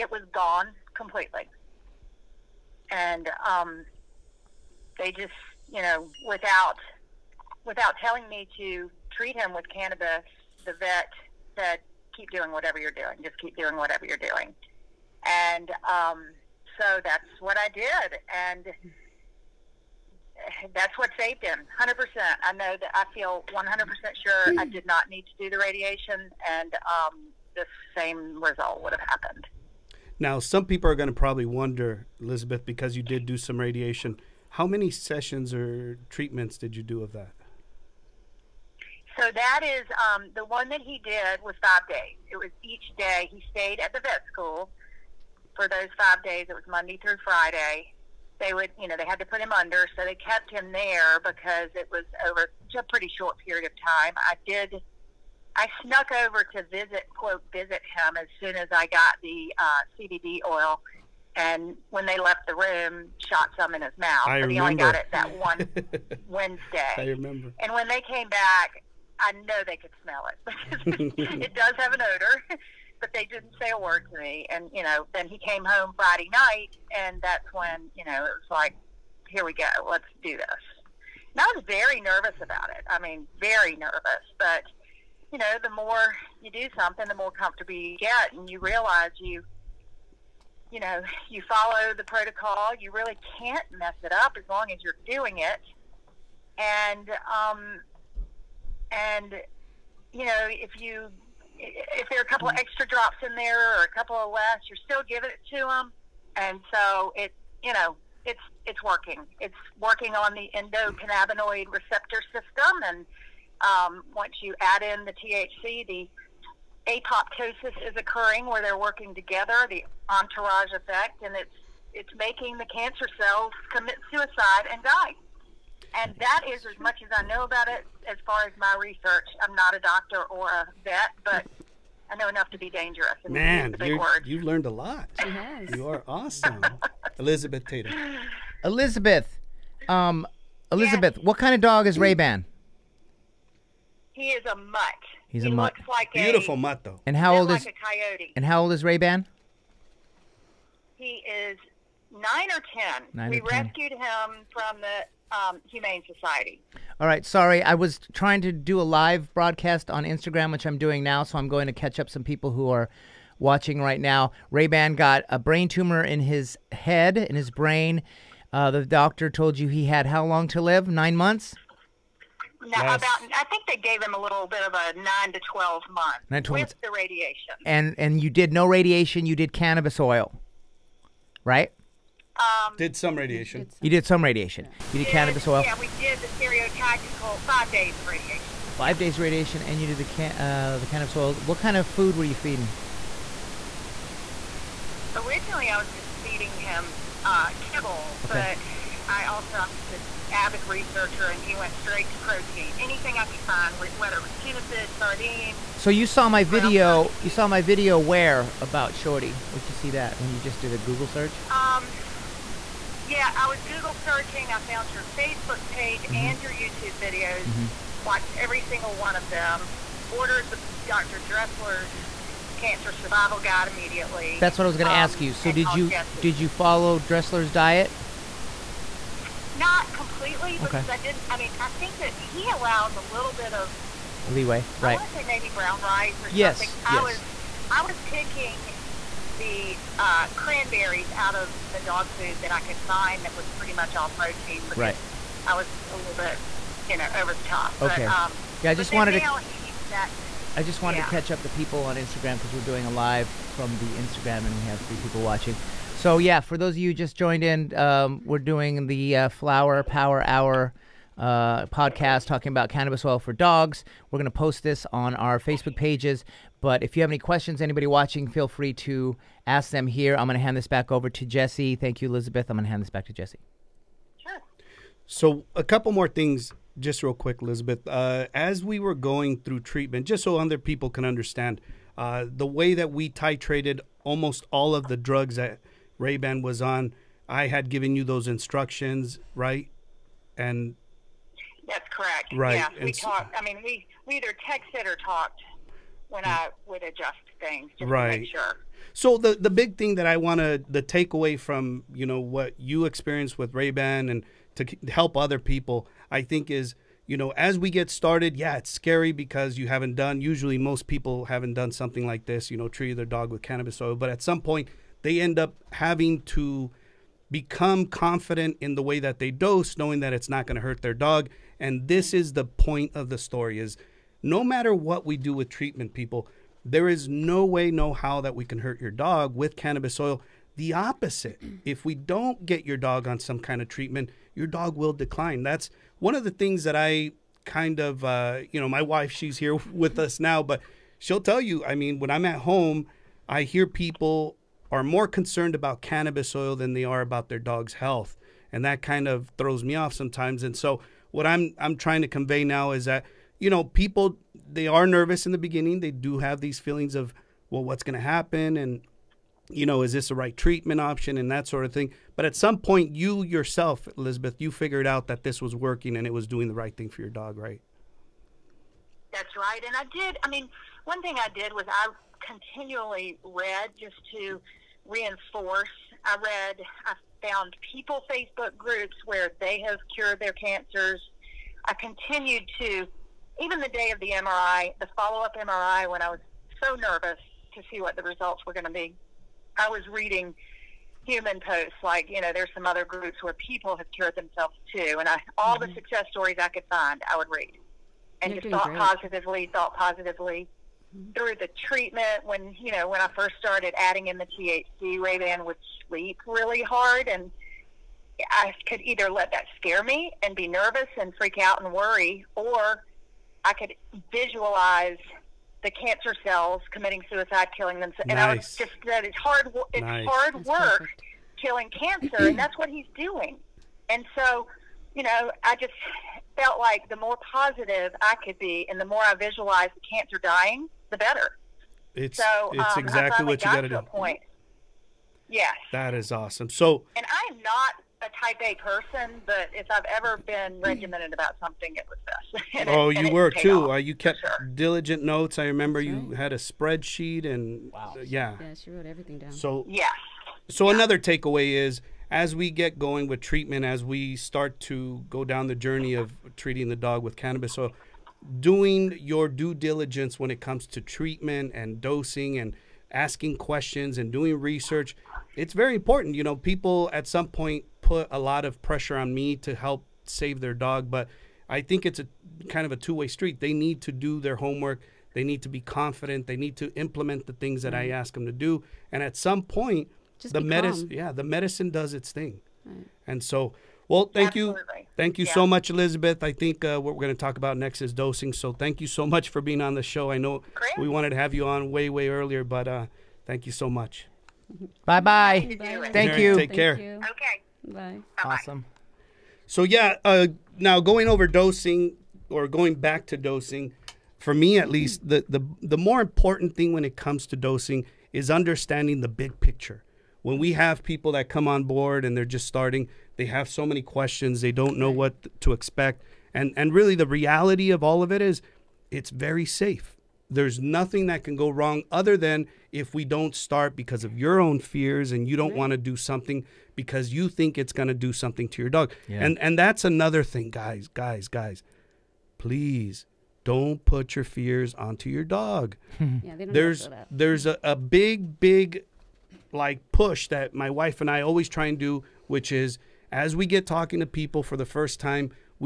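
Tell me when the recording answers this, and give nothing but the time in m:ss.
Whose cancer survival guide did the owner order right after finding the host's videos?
3:40.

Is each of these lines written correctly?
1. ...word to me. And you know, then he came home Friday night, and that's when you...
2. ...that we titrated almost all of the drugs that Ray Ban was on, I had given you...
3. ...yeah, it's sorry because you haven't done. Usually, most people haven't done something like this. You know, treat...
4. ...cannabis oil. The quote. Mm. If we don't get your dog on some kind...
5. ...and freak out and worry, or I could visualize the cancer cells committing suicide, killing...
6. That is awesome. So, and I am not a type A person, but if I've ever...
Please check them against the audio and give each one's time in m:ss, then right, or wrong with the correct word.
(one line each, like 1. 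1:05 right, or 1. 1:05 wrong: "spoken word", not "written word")
1. 1:13 right
2. 4:42 right
3. 5:08 wrong: "scary", not "sorry"
4. 5:29 wrong: "opposite", not "quote"
5. 6:50 right
6. 7:15 right.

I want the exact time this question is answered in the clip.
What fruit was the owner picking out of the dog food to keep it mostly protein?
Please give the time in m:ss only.
4:00.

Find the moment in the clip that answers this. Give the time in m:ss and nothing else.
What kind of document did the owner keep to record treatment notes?
7:26.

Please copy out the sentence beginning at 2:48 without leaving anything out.
Uh, the doctor told you he had how long to live?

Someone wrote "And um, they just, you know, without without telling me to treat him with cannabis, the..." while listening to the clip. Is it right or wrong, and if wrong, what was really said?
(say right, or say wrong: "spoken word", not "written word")
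right.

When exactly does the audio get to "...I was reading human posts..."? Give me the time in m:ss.
6:29.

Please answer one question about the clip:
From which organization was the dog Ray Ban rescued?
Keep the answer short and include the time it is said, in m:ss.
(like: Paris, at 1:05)
Humane Society, at 2:35.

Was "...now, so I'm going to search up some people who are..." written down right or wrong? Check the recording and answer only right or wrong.
wrong.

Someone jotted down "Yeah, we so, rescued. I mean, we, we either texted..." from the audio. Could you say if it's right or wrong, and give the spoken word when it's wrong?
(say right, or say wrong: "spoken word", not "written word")
wrong: "talked", not "rescued".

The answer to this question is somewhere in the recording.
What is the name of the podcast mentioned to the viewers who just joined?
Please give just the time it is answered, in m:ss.
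4:19.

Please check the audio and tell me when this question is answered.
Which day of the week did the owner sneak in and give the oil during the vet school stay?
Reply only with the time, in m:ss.
1:06.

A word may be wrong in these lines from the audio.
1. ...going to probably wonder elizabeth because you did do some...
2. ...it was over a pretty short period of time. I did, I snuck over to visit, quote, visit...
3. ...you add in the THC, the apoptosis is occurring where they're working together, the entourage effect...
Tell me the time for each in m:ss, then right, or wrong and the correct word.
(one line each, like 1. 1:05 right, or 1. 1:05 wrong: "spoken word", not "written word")
1. 0:30 right
2. 0:51 right
3. 1:54 right.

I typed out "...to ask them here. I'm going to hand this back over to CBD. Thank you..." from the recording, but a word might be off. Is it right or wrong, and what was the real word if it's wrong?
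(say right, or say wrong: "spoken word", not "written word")
wrong: "Jesse", not "CBD".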